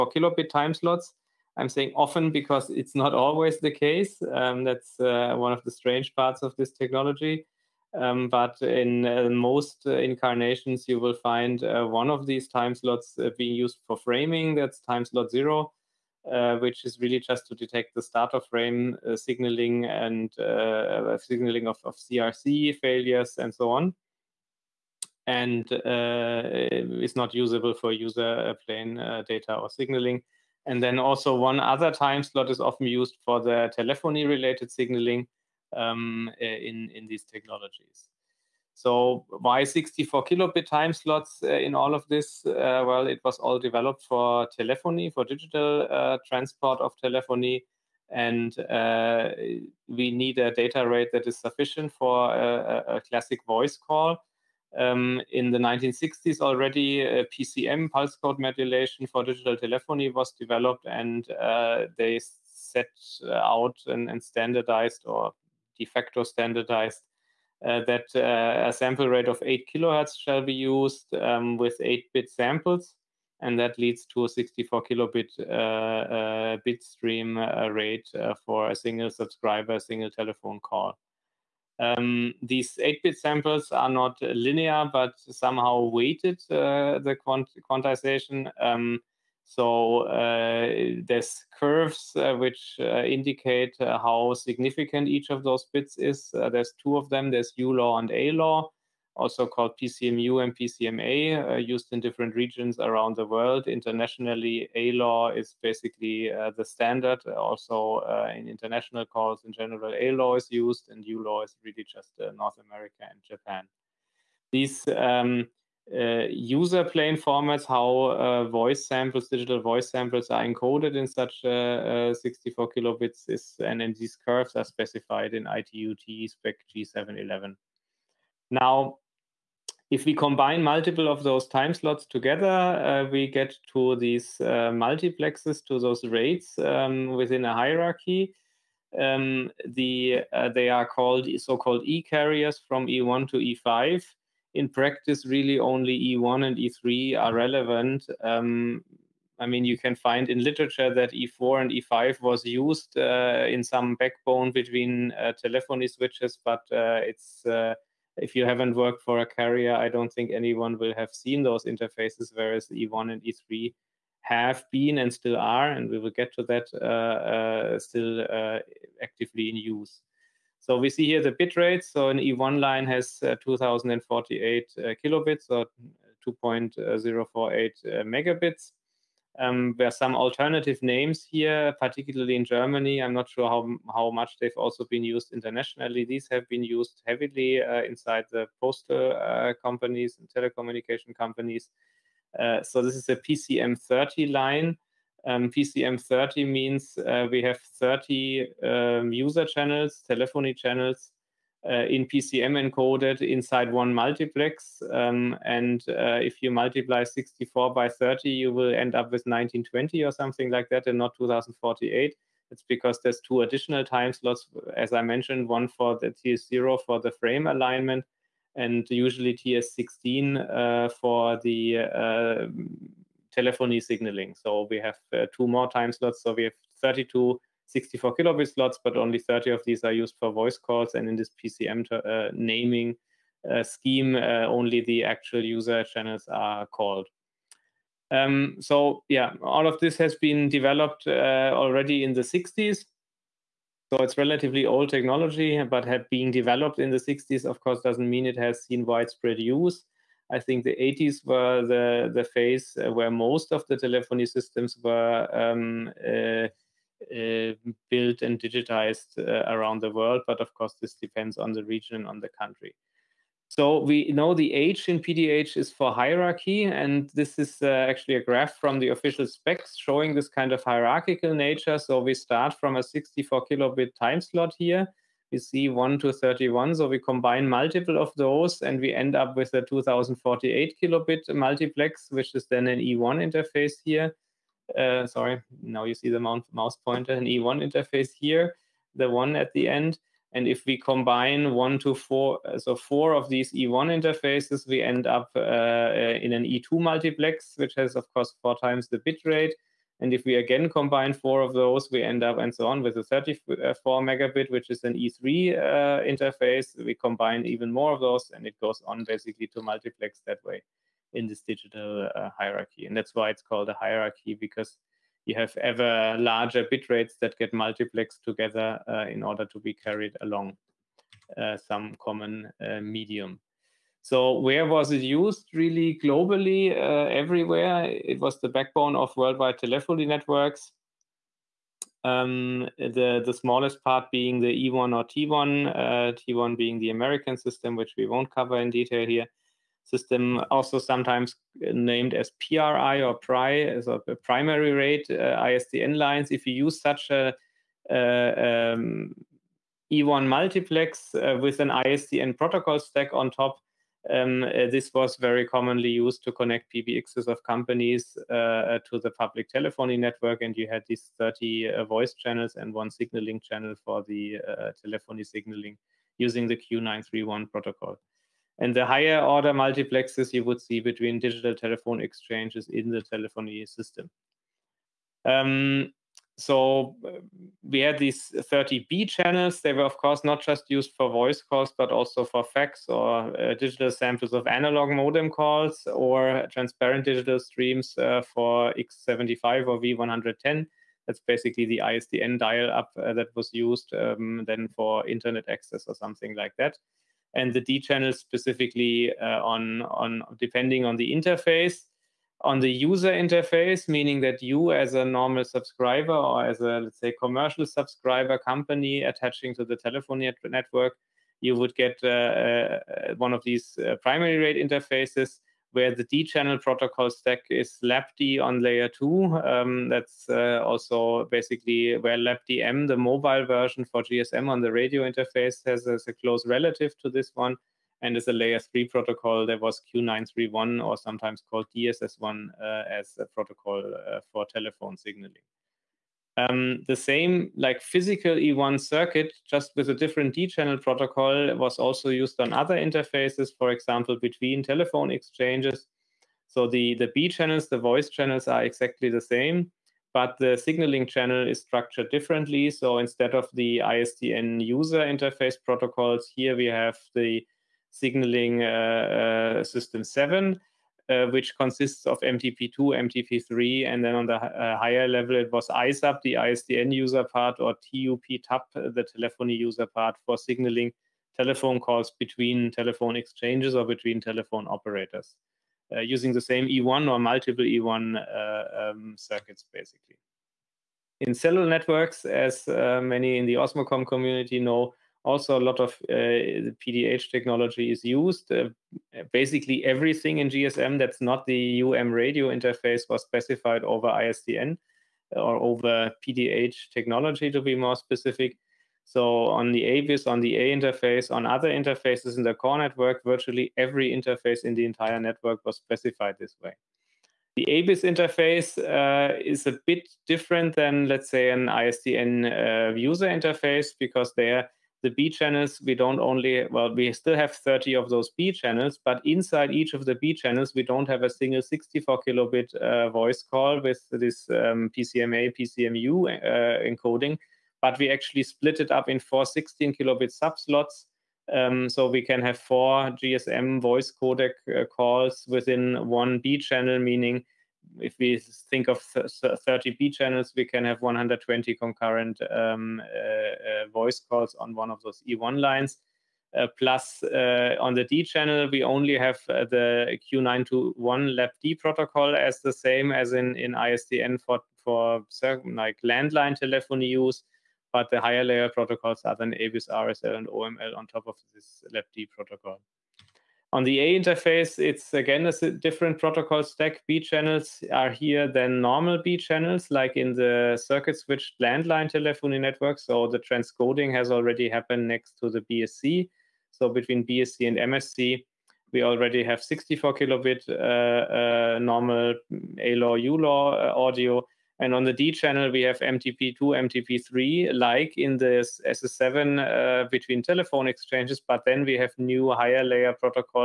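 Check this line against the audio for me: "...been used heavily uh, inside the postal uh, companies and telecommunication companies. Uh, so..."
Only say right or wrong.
right.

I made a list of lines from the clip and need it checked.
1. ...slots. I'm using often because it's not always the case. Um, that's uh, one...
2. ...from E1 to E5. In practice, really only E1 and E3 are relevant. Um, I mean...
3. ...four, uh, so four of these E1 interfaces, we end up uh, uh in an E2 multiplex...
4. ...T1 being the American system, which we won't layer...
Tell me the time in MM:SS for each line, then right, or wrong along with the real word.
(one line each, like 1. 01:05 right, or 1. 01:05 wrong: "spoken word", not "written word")
1. 00:00 wrong: "saying", not "using"
2. 02:22 right
3. 04:51 right
4. 05:36 wrong: "cover", not "layer".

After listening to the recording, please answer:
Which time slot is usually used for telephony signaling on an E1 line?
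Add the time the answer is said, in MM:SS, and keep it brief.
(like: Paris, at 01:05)
TS16, at 03:39.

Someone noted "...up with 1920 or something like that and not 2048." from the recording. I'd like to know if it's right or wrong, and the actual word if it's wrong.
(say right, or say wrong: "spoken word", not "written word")
right.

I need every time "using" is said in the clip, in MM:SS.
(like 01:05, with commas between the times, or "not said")
06:06, 07:55.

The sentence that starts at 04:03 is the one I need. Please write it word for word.
So it's relatively old technology, but have developed in the 60s, of course, doesn't mean it has seen widespread use.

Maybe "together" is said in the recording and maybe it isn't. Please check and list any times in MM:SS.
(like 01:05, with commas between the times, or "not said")
02:12, 05:18.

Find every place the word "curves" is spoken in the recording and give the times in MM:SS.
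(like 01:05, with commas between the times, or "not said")
01:31, 02:04.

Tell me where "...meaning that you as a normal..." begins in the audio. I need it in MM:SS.
06:43.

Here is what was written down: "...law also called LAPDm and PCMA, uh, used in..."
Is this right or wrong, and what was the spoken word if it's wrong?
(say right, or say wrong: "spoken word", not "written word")
wrong: "PCMU", not "LAPDm".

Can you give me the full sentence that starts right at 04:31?
So we start from a 64 kilobit time slot here.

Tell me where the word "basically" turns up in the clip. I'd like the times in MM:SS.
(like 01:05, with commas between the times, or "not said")
01:45, 05:09, 06:31, 07:01, 07:59, 08:09.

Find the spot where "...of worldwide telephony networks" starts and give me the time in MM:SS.
05:28.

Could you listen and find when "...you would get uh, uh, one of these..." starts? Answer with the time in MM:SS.
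06:51.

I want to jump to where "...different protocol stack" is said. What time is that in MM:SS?
09:25.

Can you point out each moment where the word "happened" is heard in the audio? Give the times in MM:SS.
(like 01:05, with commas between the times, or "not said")
09:34.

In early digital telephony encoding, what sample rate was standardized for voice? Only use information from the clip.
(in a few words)
8 kilohertz.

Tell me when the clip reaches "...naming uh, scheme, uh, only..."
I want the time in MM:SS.
03:52.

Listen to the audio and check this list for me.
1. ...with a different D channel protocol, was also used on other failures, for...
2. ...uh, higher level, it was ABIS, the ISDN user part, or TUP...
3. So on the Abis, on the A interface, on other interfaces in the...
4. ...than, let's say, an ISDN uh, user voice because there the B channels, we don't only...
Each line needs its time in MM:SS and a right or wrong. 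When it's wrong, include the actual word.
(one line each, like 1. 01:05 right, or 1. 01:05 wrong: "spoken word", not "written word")
1. 07:19 wrong: "interfaces", not "failures"
2. 07:44 wrong: "ISUP", not "ABIS"
3. 08:19 right
4. 08:30 wrong: "interface", not "voice".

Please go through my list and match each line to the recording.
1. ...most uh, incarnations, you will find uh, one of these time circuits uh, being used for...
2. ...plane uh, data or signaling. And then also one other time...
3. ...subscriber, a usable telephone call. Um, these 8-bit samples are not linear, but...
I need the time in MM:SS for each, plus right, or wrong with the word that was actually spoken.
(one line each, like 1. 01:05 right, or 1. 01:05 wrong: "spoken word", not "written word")
1. 00:09 wrong: "slots", not "circuits"
2. 00:28 right
3. 01:19 wrong: "single", not "usable".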